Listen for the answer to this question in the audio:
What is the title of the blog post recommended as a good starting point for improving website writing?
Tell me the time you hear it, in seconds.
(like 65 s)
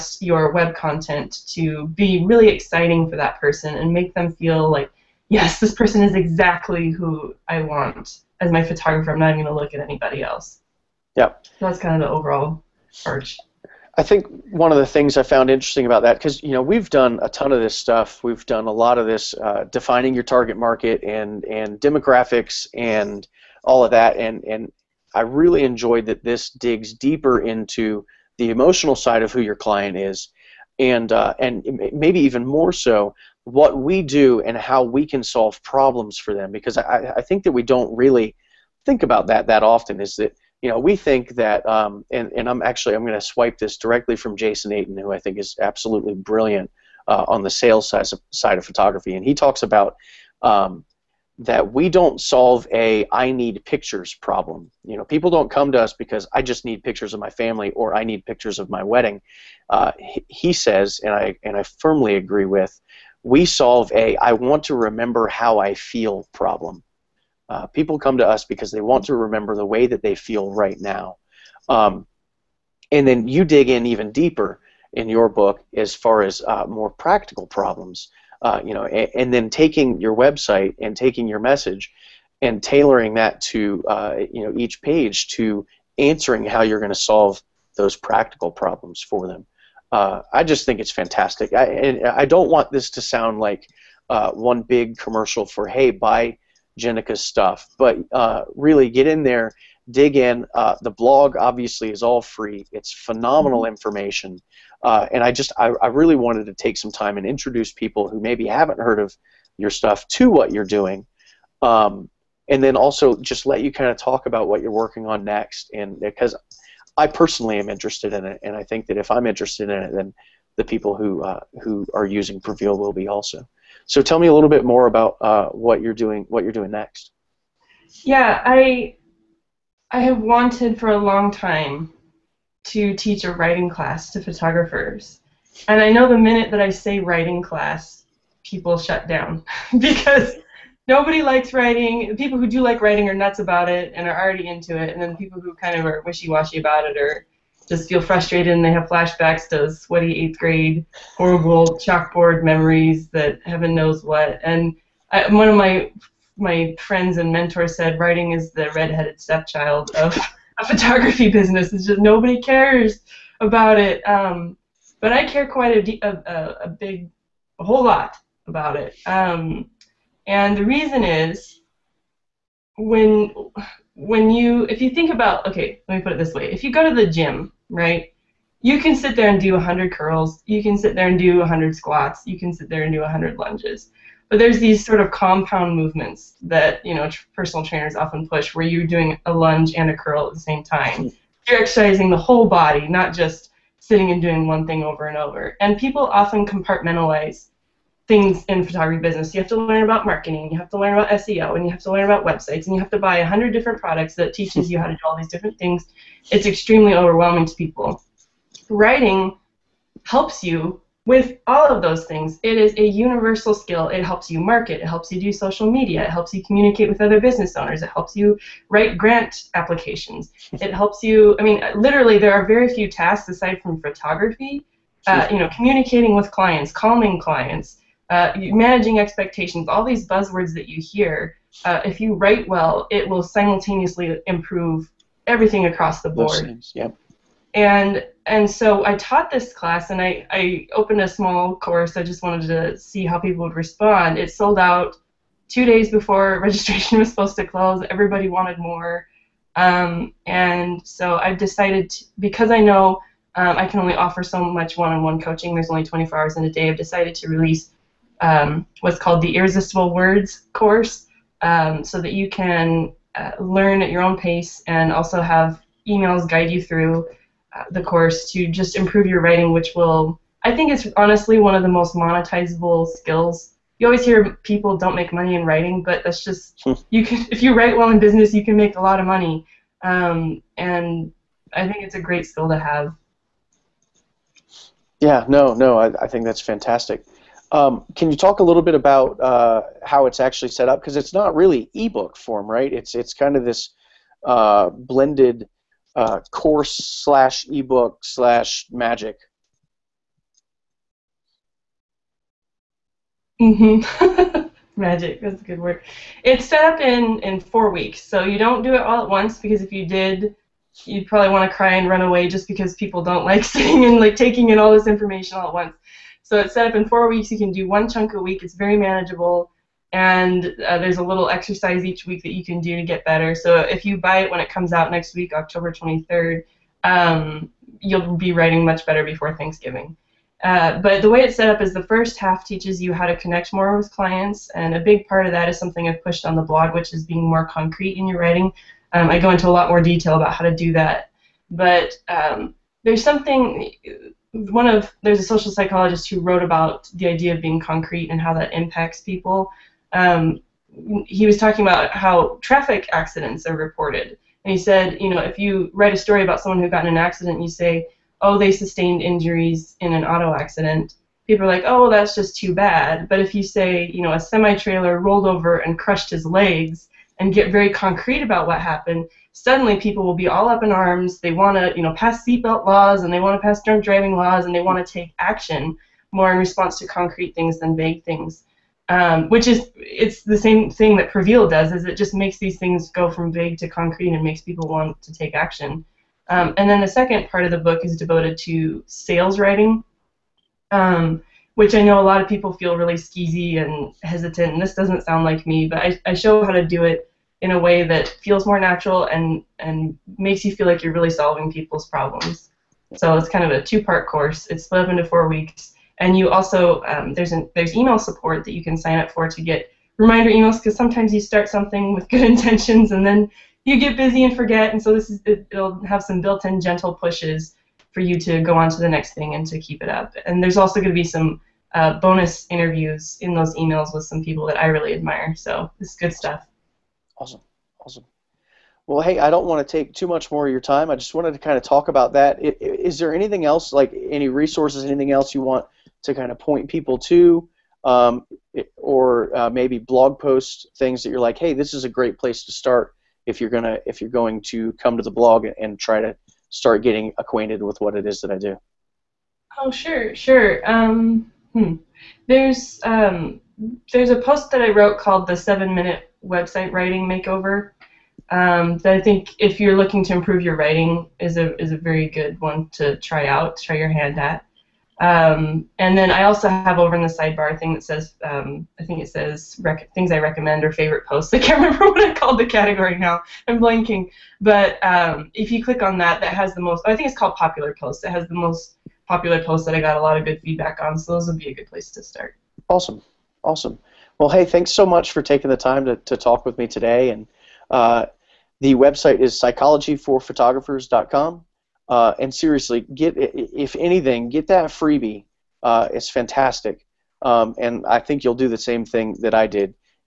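455 s.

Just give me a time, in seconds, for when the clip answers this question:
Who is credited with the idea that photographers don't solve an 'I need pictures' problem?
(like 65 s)
44 s.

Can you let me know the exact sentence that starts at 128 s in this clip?
Yeah, I I have wanted for a long time to teach a writing class to photographers.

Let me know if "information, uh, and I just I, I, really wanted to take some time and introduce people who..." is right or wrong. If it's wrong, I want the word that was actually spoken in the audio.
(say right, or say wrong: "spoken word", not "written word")
right.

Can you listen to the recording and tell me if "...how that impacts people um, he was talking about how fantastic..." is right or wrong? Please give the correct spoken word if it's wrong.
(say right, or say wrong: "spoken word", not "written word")
wrong: "traffic", not "fantastic".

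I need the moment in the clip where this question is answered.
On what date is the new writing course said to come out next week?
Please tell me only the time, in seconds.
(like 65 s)
325 s.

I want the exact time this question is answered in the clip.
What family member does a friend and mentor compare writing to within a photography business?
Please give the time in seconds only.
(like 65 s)
158 s.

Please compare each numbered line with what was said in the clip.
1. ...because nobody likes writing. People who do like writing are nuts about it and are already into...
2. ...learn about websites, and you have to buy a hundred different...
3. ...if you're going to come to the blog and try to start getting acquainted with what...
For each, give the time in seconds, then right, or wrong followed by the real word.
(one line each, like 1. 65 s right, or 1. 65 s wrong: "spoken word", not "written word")
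1. 139 s right
2. 201 s right
3. 443 s right.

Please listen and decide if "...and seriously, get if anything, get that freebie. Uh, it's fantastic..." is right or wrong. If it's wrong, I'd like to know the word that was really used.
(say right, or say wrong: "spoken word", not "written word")
right.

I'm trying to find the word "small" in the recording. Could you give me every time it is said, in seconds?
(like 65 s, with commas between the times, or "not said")
241 s.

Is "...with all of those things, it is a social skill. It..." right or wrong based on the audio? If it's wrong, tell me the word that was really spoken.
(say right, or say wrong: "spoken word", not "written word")
wrong: "universal", not "social".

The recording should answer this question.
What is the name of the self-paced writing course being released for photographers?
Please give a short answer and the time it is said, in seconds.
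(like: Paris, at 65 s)
Irresistible Words, at 259 s.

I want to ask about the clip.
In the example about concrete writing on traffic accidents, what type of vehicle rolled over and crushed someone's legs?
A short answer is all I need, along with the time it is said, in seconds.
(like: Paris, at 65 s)
semi trailer, at 364 s.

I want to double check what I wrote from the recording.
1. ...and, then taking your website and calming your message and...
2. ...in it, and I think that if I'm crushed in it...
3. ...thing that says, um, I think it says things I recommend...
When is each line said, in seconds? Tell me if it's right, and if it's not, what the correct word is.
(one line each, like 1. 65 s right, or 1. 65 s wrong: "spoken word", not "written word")
1. 79 s wrong: "taking", not "calming"
2. 118 s wrong: "interested", not "crushed"
3. 467 s right.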